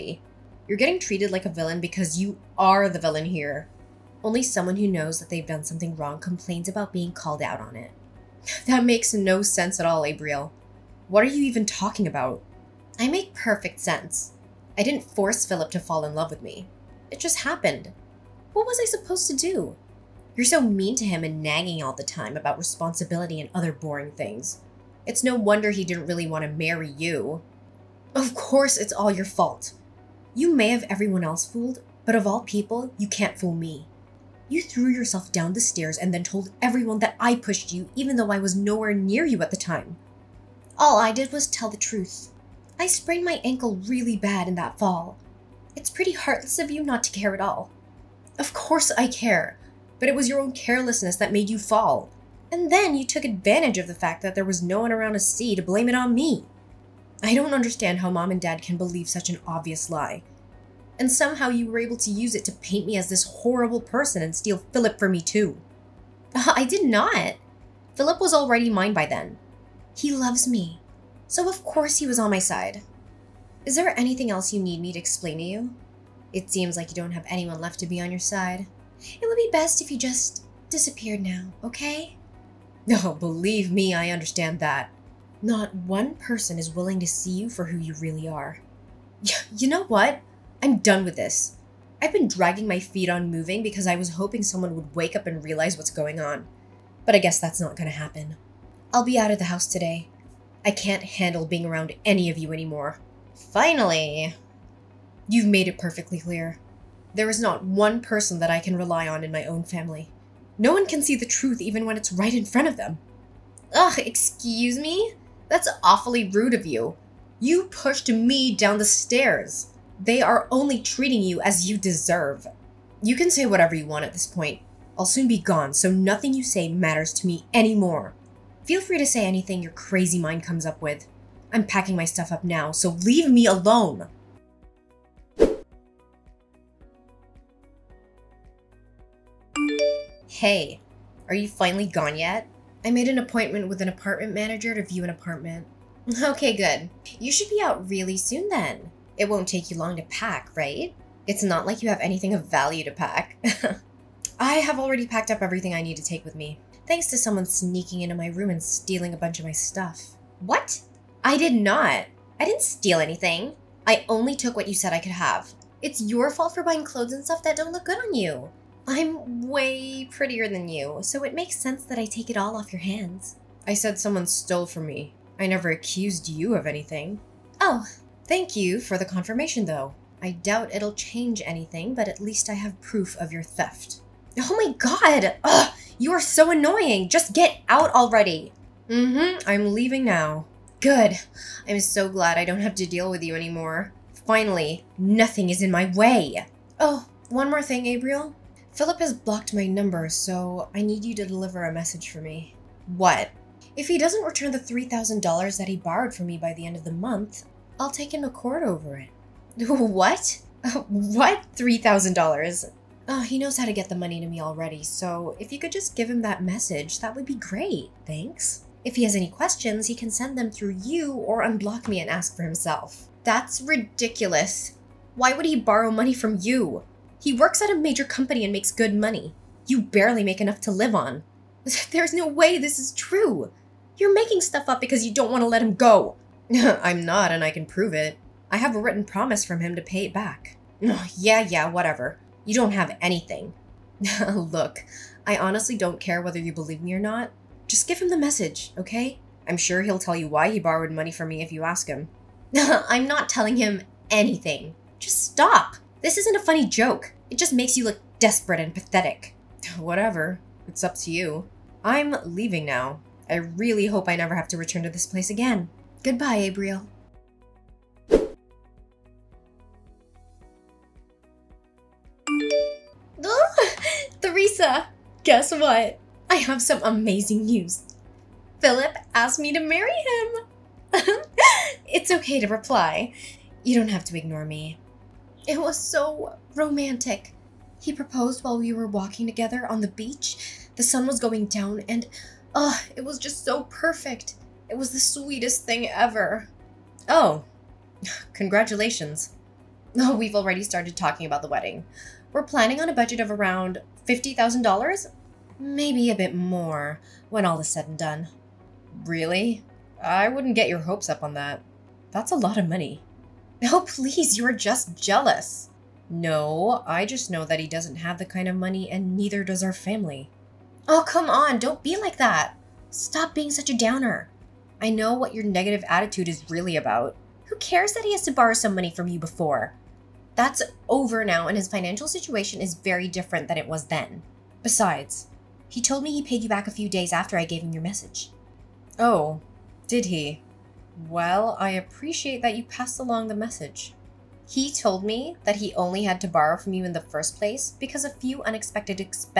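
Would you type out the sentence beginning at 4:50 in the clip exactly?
The sun was going down and, oh, uh, it was just so perfect.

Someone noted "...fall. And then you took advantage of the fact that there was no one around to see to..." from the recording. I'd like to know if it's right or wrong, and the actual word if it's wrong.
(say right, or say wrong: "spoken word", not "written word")
right.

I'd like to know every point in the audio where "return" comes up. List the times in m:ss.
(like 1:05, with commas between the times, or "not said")
3:24, 4:24.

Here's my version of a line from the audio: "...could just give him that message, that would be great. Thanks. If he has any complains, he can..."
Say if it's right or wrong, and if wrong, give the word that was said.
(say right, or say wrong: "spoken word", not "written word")
wrong: "questions", not "complains".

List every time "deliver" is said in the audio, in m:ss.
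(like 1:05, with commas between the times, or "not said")
3:21.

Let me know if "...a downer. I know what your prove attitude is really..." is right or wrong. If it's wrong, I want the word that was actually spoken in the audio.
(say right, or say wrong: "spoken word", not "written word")
wrong: "negative", not "prove".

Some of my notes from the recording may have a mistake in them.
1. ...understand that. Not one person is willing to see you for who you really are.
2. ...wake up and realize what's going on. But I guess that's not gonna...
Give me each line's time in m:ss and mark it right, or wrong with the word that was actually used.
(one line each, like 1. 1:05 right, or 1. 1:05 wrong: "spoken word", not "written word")
1. 1:24 right
2. 1:34 right.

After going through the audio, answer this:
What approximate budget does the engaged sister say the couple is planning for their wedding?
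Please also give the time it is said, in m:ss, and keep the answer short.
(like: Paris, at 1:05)
$50,000, at 5:04.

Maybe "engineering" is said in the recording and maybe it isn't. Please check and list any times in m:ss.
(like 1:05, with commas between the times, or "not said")
not said.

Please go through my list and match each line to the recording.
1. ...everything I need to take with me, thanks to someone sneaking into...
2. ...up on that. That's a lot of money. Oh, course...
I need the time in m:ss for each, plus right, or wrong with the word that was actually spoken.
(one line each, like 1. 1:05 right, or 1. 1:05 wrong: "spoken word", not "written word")
1. 2:35 right
2. 5:11 wrong: "please", not "course".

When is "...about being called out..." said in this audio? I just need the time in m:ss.
0:06.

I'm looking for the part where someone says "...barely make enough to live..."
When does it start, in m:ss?
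3:49.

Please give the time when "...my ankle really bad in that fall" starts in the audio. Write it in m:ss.
0:43.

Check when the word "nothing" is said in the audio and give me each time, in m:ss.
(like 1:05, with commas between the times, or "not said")
2:05, 3:14.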